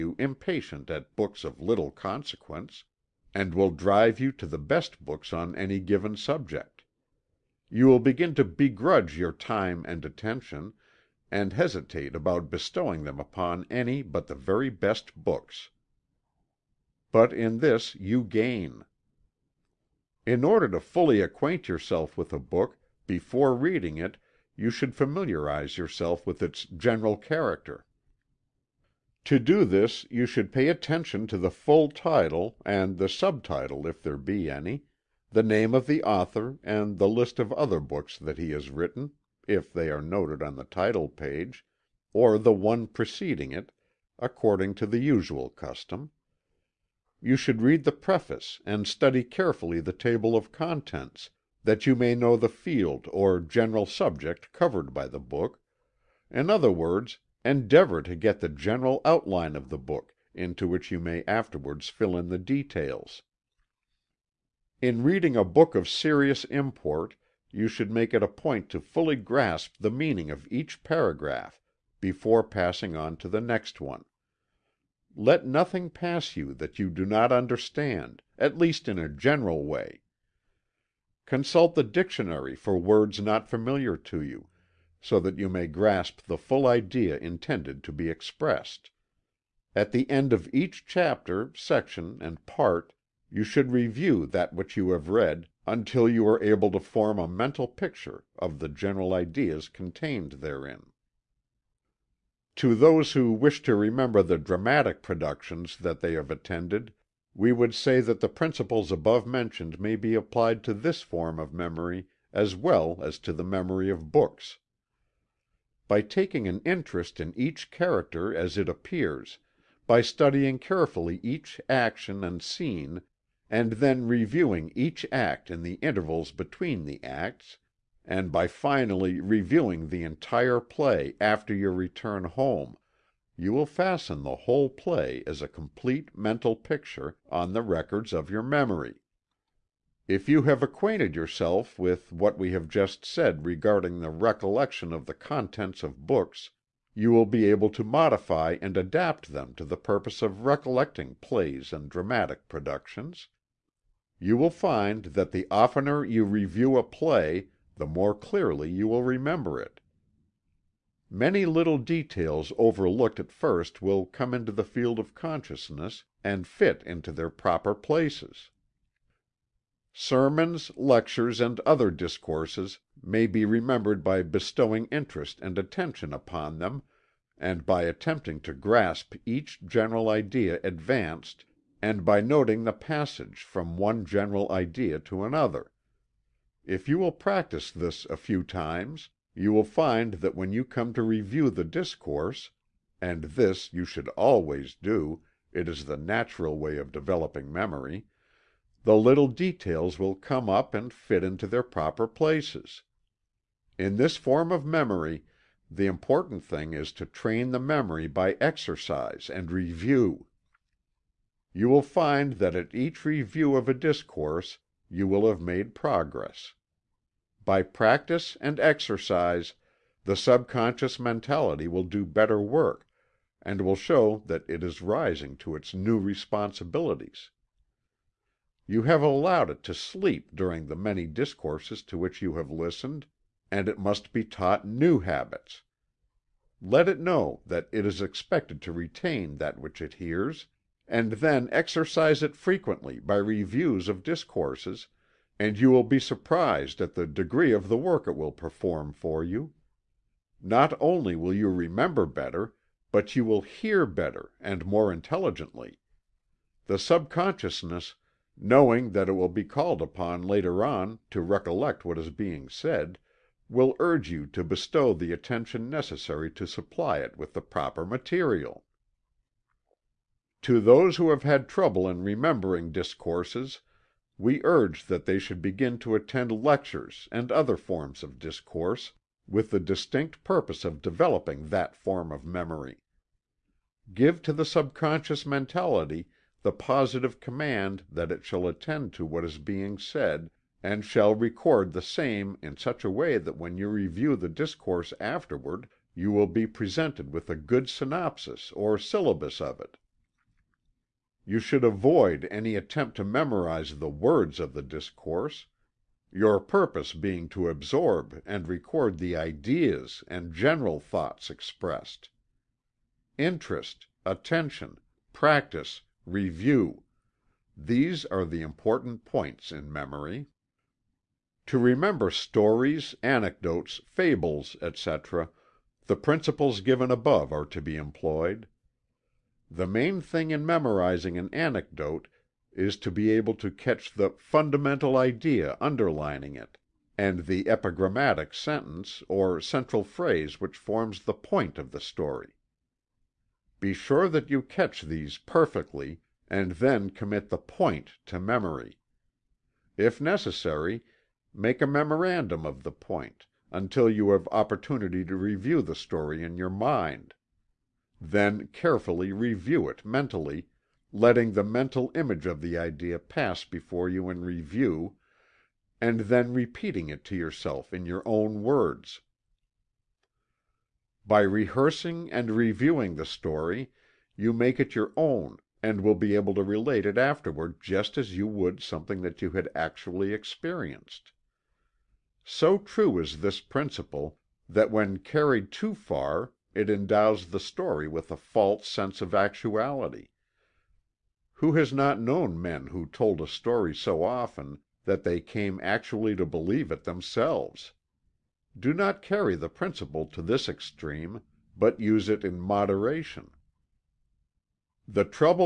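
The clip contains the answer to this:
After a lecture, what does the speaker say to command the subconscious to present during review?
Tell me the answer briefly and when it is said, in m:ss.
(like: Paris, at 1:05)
a good synopsis or syllabus, at 4:57.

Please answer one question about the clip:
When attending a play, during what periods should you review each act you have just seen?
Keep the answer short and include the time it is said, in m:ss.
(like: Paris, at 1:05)
intervals between the acts, at 2:05.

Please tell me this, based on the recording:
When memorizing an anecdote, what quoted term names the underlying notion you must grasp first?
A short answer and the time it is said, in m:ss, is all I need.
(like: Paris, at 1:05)
fundamental idea, at 5:34.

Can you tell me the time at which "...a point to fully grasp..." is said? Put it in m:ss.
1:08.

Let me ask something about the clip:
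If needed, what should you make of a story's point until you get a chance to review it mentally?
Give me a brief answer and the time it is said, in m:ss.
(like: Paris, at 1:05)
a memorandum, at 5:51.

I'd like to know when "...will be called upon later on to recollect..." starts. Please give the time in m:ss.
4:19.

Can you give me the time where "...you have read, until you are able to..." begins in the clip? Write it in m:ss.
1:34.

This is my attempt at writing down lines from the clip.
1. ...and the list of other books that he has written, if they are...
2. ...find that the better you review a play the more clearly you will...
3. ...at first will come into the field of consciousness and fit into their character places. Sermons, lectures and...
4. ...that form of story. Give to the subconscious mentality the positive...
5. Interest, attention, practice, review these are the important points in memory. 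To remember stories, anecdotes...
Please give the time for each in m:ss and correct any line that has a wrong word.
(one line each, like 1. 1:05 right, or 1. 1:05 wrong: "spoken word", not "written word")
1. 0:36 right
2. 2:34 wrong: "oftener", not "better"
3. 2:43 wrong: "proper", not "character"
4. 4:41 wrong: "memory", not "story"
5. 5:13 right.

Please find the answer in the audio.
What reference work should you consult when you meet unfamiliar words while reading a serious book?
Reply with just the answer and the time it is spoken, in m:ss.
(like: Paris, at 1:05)
the dictionary, at 1:21.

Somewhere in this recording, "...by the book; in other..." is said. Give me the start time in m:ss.
0:54.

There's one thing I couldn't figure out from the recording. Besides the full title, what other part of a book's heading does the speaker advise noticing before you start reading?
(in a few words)
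the subtitle.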